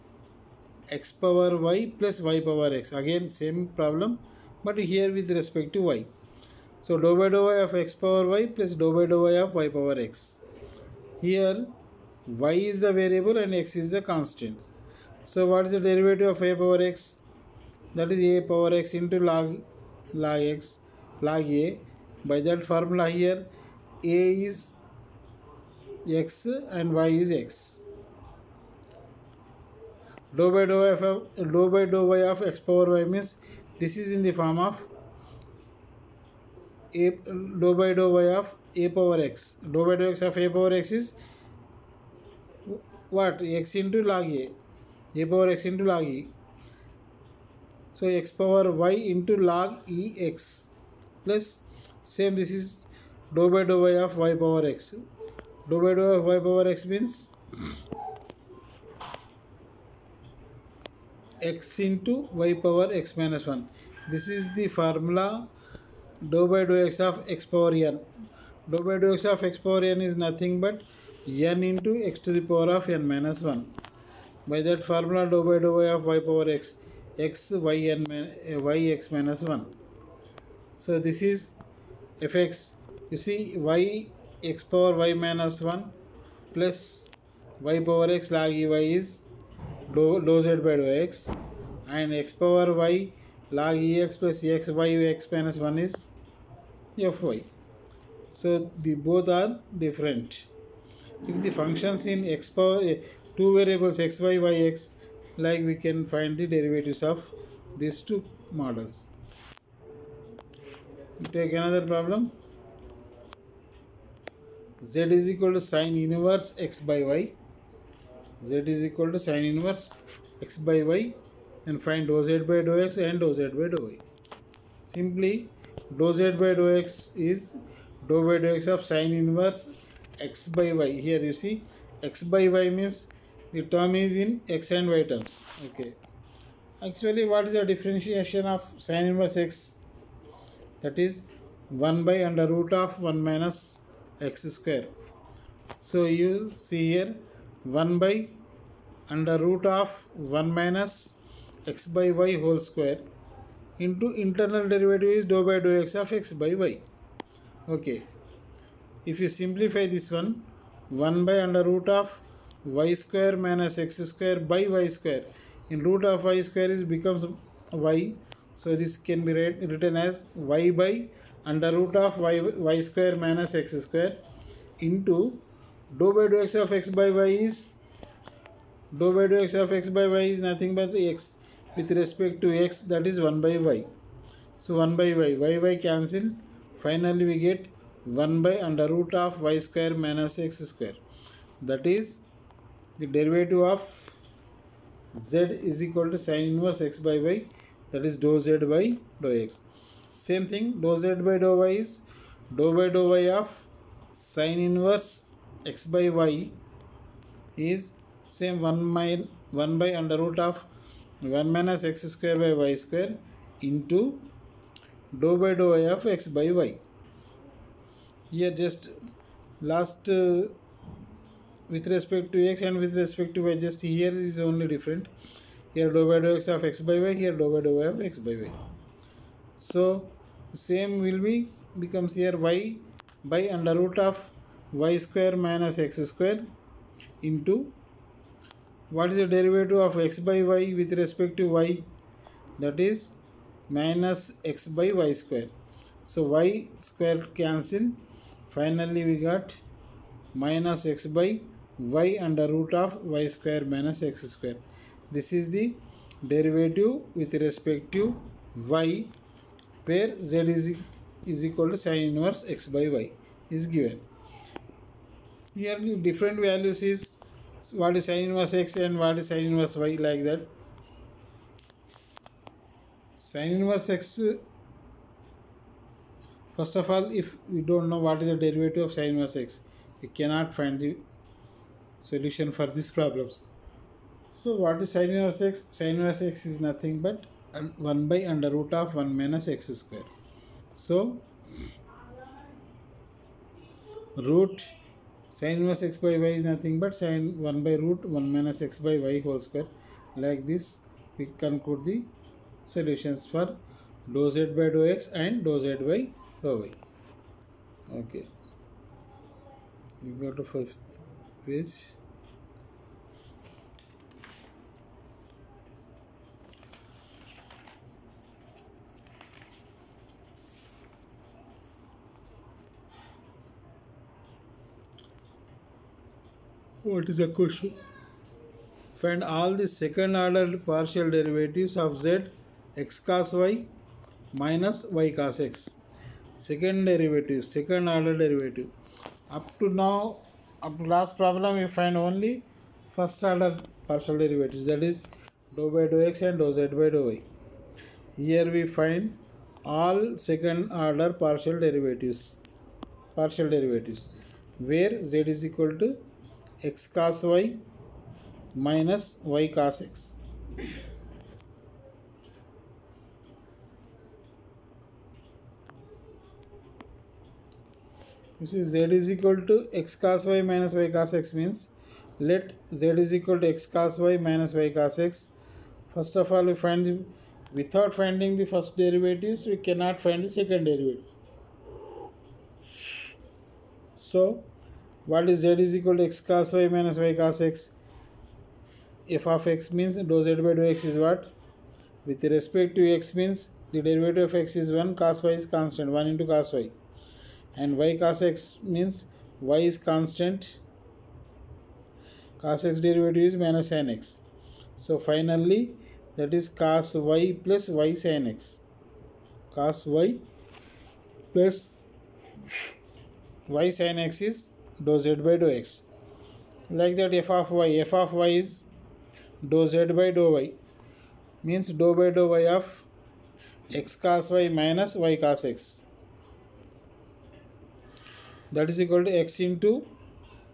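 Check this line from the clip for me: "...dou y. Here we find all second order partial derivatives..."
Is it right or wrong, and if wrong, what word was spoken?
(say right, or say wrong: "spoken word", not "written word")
right.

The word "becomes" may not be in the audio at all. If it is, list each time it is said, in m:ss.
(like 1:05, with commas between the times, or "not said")
2:46, 3:51.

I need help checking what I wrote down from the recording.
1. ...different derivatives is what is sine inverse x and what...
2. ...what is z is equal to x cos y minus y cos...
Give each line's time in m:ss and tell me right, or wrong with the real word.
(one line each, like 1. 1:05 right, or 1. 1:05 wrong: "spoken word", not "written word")
1. 4:26 wrong: "values", not "derivatives"
2. 6:25 right.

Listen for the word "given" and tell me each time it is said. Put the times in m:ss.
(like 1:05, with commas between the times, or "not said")
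4:23.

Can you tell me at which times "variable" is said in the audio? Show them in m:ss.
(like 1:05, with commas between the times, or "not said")
0:13, 1:43.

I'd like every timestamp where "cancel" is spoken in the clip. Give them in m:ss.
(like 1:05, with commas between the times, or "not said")
3:05, 4:07.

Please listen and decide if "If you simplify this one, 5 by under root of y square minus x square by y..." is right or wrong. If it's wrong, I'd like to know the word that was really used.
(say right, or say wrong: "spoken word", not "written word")
wrong: "1", not "5".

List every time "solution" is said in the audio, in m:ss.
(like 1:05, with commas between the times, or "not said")
4:42, 5:02.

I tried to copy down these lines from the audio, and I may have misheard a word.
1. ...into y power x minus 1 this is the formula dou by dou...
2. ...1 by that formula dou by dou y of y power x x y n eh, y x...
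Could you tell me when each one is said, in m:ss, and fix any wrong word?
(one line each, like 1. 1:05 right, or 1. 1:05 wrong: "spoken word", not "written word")
1. 1:01 right
2. 1:13 right.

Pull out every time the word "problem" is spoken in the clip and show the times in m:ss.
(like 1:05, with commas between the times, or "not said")
0:03, 1:51, 4:42, 5:41.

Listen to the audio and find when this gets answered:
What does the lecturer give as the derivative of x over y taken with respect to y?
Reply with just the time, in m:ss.
4:03.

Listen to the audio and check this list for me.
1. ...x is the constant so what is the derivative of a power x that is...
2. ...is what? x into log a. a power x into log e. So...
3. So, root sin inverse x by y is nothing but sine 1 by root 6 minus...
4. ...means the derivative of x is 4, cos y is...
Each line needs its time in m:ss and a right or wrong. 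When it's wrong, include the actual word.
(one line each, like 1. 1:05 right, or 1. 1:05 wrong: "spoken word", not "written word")
1. 0:13 right
2. 0:40 right
3. 4:50 wrong: "1", not "6"
4. 6:33 wrong: "1", not "4".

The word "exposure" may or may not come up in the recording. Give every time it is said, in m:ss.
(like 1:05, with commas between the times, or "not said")
not said.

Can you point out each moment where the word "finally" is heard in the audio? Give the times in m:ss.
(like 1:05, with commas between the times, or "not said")
3:06, 4:08, 6:44.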